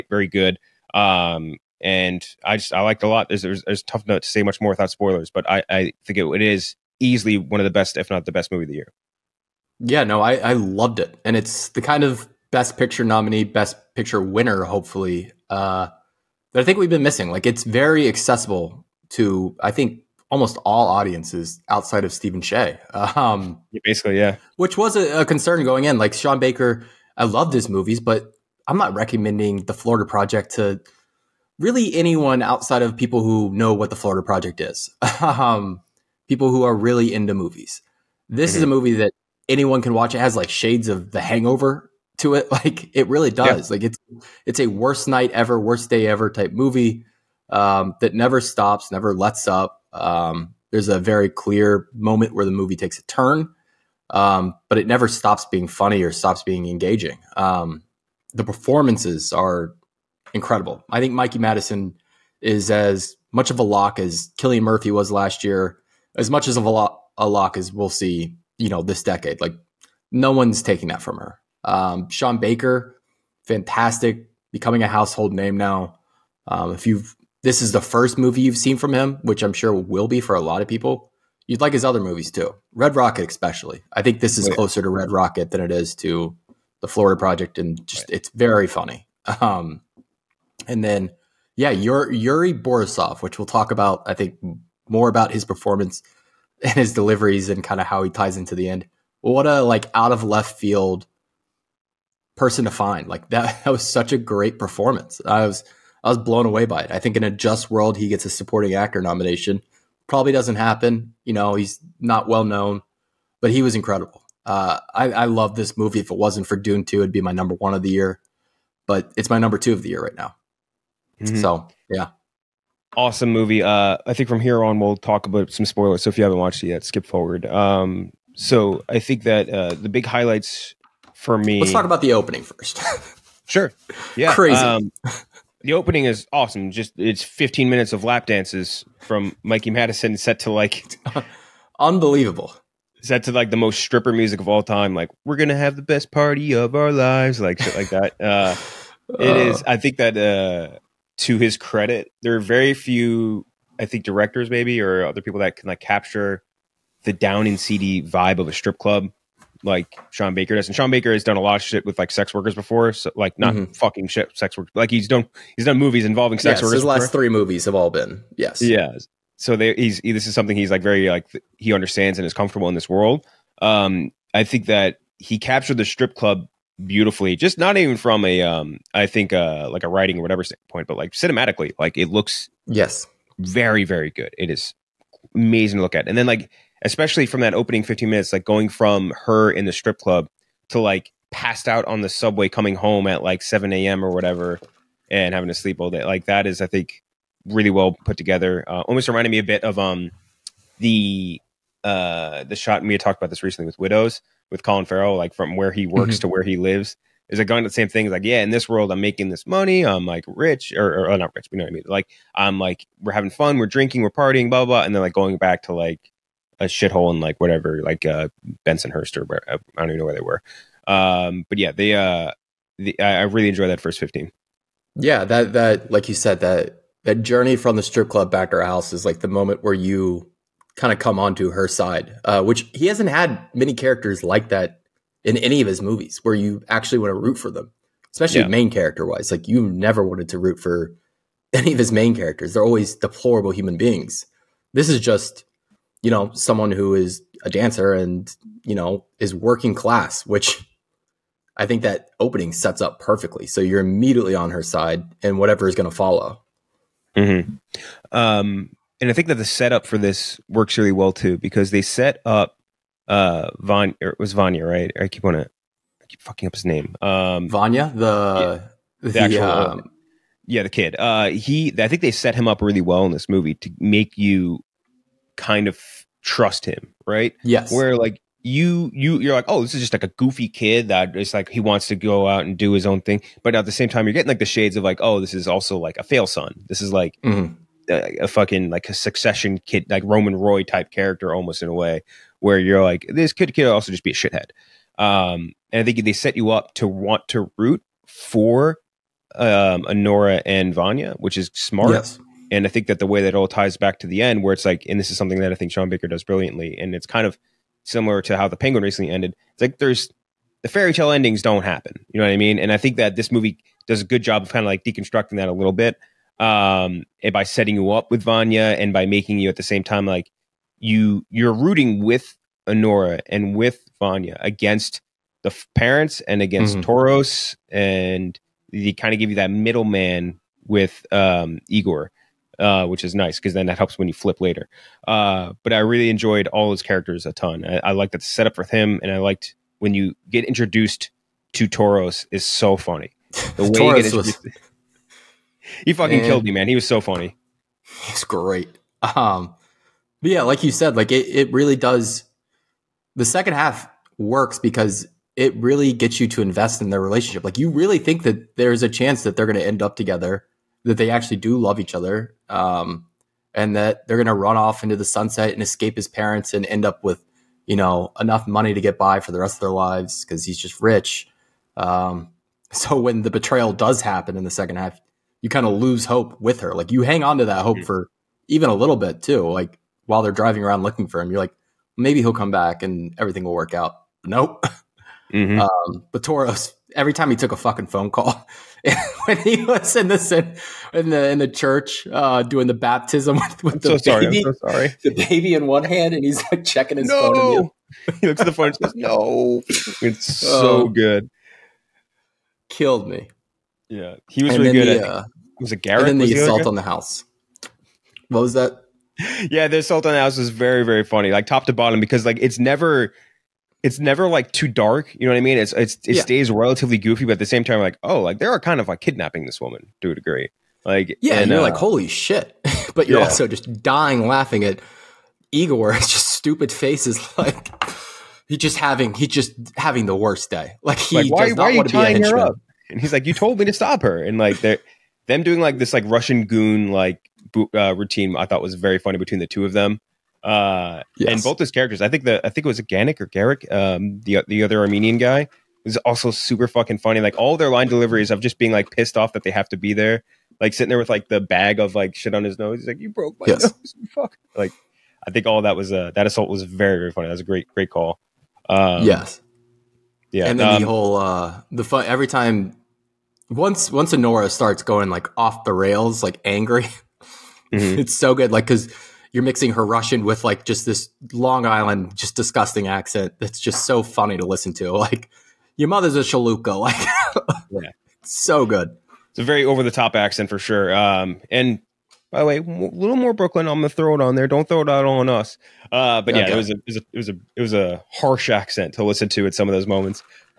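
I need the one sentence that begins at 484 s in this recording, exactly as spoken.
Don't throw it out on us.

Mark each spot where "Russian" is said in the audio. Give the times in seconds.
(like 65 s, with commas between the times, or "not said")
436 s, 469 s.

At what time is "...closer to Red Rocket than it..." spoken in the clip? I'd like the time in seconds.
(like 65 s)
84 s.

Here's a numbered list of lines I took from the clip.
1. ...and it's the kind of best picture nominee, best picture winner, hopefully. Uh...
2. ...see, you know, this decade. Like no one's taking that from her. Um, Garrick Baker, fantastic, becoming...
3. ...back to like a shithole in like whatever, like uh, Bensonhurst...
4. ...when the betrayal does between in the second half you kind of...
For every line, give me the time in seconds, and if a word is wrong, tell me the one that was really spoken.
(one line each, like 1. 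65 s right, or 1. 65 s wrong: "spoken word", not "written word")
1. 11 s right
2. 67 s wrong: "Sean", not "Garrick"
3. 215 s right
4. 372 s wrong: "happen", not "between".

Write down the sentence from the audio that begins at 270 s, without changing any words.
Uh, he, I think they set him up really well in this movie to make you kind of trust him, right?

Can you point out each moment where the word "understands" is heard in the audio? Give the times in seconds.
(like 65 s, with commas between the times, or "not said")
171 s.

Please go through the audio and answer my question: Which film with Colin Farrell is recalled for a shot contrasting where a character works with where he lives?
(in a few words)
Widows.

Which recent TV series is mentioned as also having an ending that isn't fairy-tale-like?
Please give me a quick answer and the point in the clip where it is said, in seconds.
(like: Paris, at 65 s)
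The Penguin, at 308 s.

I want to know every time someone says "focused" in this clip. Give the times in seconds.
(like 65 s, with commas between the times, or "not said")
not said.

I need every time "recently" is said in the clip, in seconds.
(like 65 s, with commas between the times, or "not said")
203 s, 308 s.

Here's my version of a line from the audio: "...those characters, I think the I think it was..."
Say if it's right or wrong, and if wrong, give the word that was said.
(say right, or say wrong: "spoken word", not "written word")
right.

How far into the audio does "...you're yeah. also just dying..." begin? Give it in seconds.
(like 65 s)
423 s.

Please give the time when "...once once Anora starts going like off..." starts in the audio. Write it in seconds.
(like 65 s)
463 s.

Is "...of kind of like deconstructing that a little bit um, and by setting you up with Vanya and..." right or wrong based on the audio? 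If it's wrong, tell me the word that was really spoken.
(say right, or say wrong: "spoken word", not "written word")
right.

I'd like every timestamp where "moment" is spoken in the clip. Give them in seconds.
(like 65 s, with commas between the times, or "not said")
51 s, 229 s, 489 s.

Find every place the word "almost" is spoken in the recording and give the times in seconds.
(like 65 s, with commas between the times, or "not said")
20 s, 198 s, 291 s.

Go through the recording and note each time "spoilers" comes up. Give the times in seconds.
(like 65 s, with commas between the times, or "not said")
4 s, 125 s.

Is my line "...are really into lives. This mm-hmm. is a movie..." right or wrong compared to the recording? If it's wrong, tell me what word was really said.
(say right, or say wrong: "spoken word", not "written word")
wrong: "movies", not "lives".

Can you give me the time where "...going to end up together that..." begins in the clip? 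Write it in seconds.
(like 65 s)
359 s.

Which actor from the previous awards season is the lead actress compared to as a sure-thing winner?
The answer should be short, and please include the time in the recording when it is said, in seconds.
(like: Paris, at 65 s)
Cillian Murphy, at 64 s.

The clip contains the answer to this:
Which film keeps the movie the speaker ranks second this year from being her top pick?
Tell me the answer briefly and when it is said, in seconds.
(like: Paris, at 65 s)
Dune 2, at 116 s.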